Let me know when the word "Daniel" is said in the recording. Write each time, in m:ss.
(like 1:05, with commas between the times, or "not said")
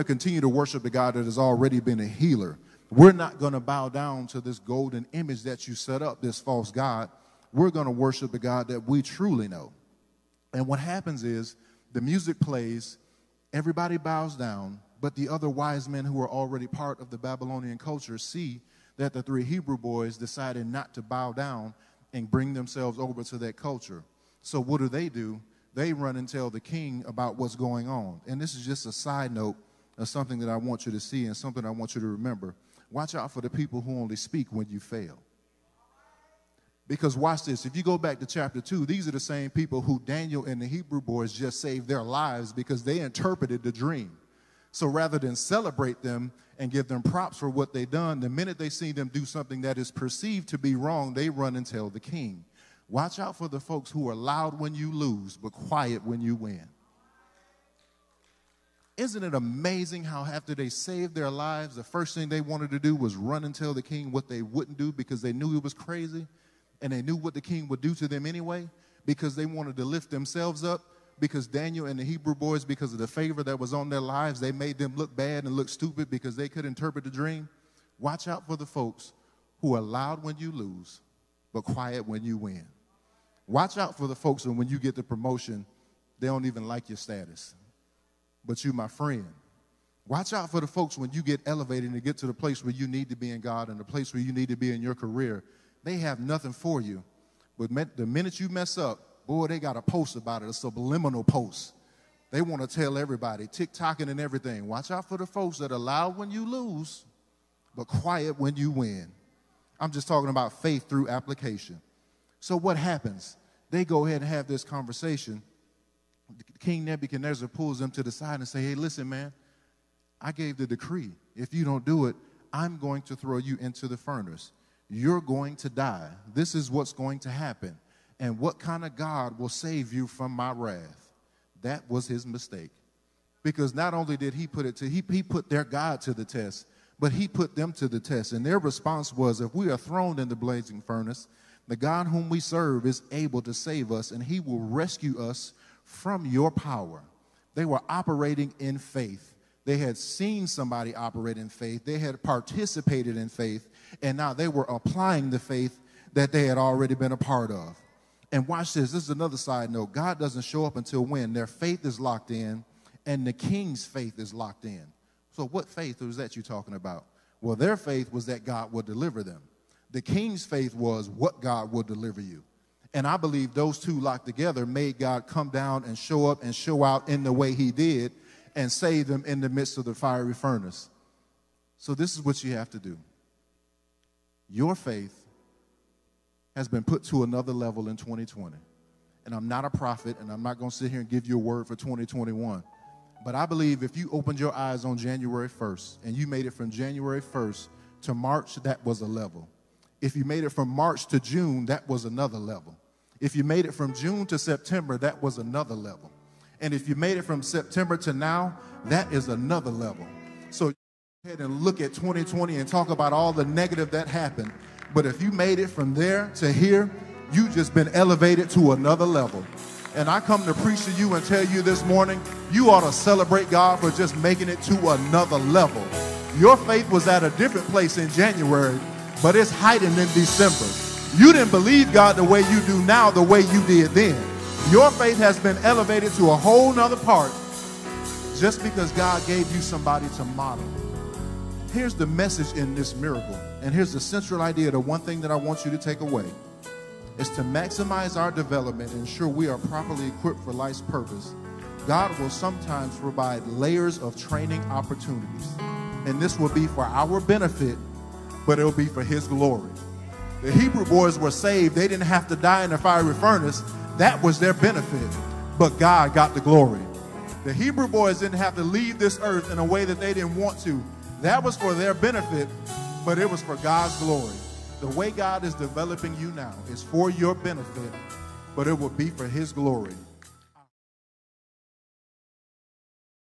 0:40, 1:11.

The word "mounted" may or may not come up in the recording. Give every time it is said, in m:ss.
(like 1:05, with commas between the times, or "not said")
not said.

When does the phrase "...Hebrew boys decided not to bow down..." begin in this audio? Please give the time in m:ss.
0:19.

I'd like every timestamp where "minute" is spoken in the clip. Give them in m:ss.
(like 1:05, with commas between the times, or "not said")
0:48, 1:38.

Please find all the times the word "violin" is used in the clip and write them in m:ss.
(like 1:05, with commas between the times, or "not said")
not said.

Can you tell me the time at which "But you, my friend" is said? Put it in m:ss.
1:28.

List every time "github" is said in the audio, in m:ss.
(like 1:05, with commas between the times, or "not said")
not said.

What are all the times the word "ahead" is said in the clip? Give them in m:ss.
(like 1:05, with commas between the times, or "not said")
1:54, 3:31.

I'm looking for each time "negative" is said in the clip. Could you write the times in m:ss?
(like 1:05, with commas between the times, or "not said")
3:33.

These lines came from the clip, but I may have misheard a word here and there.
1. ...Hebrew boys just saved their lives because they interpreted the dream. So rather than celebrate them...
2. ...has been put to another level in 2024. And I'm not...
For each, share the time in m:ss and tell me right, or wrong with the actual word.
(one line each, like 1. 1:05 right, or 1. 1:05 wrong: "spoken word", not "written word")
1. 0:40 right
2. 3:06 wrong: "2020", not "2024".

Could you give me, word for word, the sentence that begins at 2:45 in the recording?
So, what faith was that you are talking about?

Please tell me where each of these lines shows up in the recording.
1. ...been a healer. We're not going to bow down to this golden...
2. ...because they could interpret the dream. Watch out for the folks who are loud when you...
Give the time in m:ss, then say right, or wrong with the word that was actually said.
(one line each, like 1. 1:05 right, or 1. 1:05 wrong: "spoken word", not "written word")
1. 0:01 right
2. 1:16 right.